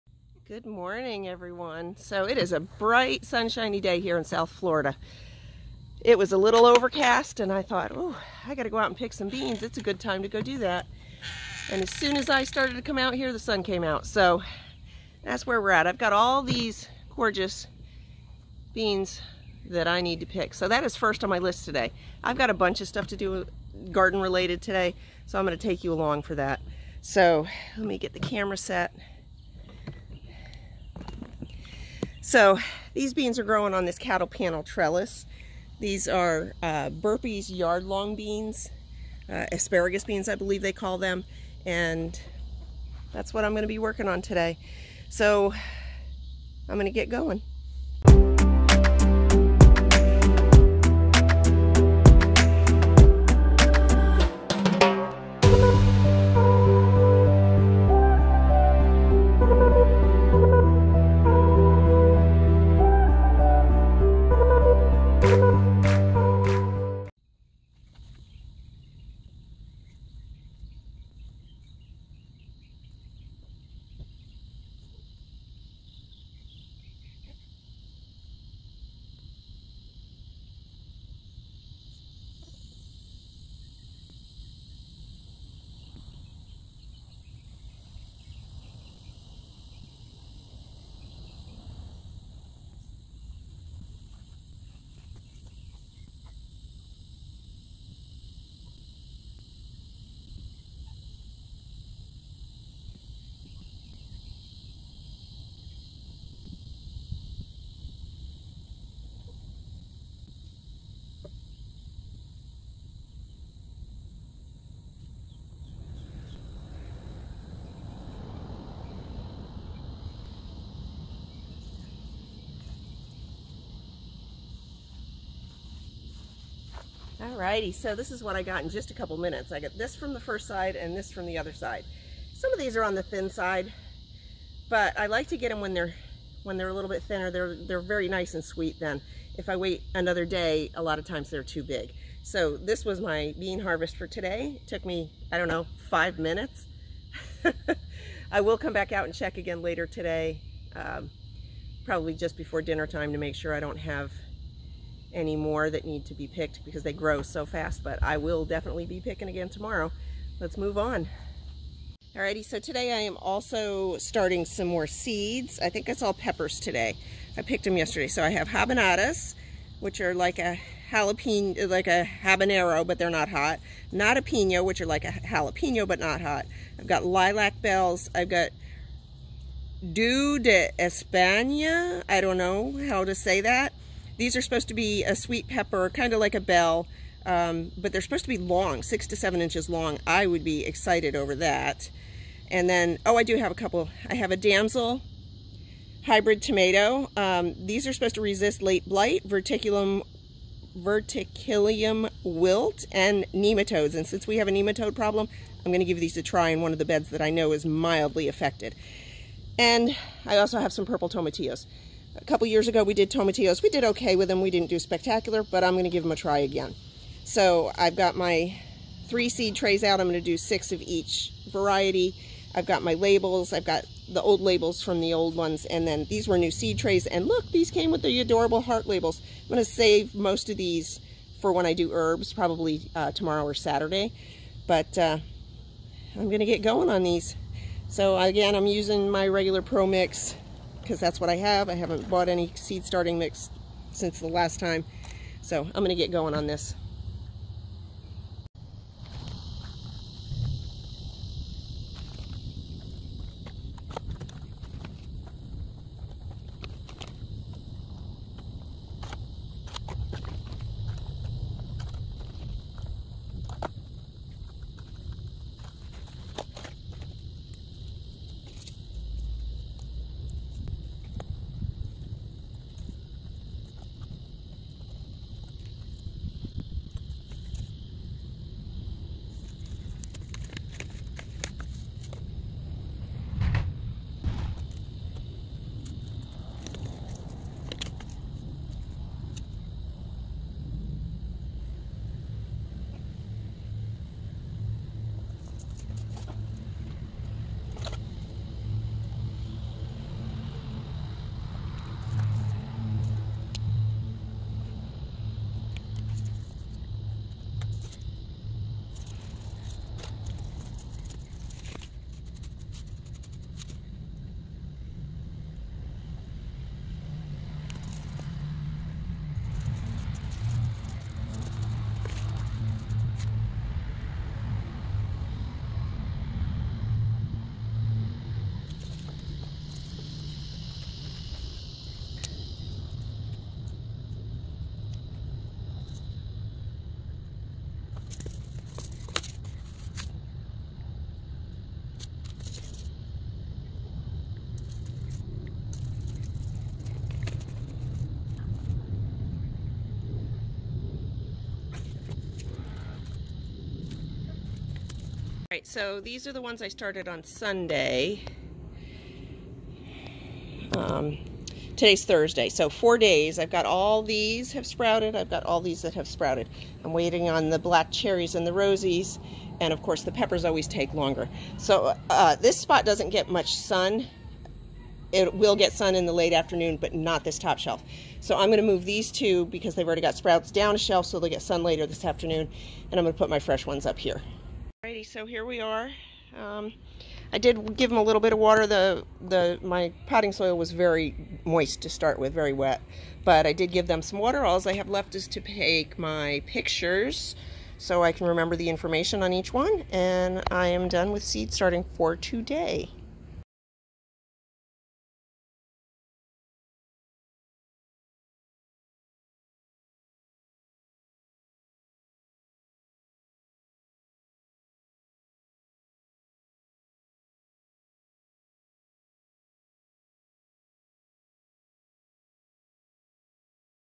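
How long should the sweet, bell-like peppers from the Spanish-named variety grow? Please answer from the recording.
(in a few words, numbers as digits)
6 to 7 inches.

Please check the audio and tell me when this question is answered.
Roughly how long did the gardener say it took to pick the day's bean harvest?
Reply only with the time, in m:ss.
2:25.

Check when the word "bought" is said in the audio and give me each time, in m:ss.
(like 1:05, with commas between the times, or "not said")
4:02.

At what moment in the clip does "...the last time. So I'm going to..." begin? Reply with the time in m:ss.
4:04.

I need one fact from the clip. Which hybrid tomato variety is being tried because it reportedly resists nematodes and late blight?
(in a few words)
Damsel.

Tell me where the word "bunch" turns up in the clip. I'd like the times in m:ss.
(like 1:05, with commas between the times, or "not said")
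0:22.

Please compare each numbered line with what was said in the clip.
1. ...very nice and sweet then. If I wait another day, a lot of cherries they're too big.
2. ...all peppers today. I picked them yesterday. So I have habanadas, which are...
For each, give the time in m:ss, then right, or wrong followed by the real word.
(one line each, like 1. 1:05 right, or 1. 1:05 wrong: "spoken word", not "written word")
1. 2:17 wrong: "times", not "cherries"
2. 2:46 right.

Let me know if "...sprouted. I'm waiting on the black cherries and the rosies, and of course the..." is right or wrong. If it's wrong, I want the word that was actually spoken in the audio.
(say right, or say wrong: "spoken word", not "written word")
right.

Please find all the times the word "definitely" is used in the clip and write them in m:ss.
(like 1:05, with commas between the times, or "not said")
2:38.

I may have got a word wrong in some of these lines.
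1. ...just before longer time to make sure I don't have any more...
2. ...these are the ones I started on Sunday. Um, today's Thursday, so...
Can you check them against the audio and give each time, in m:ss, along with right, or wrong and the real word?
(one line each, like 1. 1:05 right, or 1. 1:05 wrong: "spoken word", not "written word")
1. 2:32 wrong: "dinner", not "longer"
2. 5:55 right.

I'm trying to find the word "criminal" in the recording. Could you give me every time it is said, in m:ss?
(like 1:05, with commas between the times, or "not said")
not said.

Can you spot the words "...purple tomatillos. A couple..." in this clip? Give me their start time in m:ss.
3:30.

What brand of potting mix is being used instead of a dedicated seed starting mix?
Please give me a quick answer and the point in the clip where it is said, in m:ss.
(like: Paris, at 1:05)
Pro Mix, at 3:59.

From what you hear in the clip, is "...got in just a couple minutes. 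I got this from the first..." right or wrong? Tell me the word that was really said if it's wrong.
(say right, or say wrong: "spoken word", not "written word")
right.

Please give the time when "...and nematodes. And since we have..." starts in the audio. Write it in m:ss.
3:22.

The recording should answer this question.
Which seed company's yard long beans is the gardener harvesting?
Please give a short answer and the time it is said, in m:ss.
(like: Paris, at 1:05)
Burpee's, at 0:36.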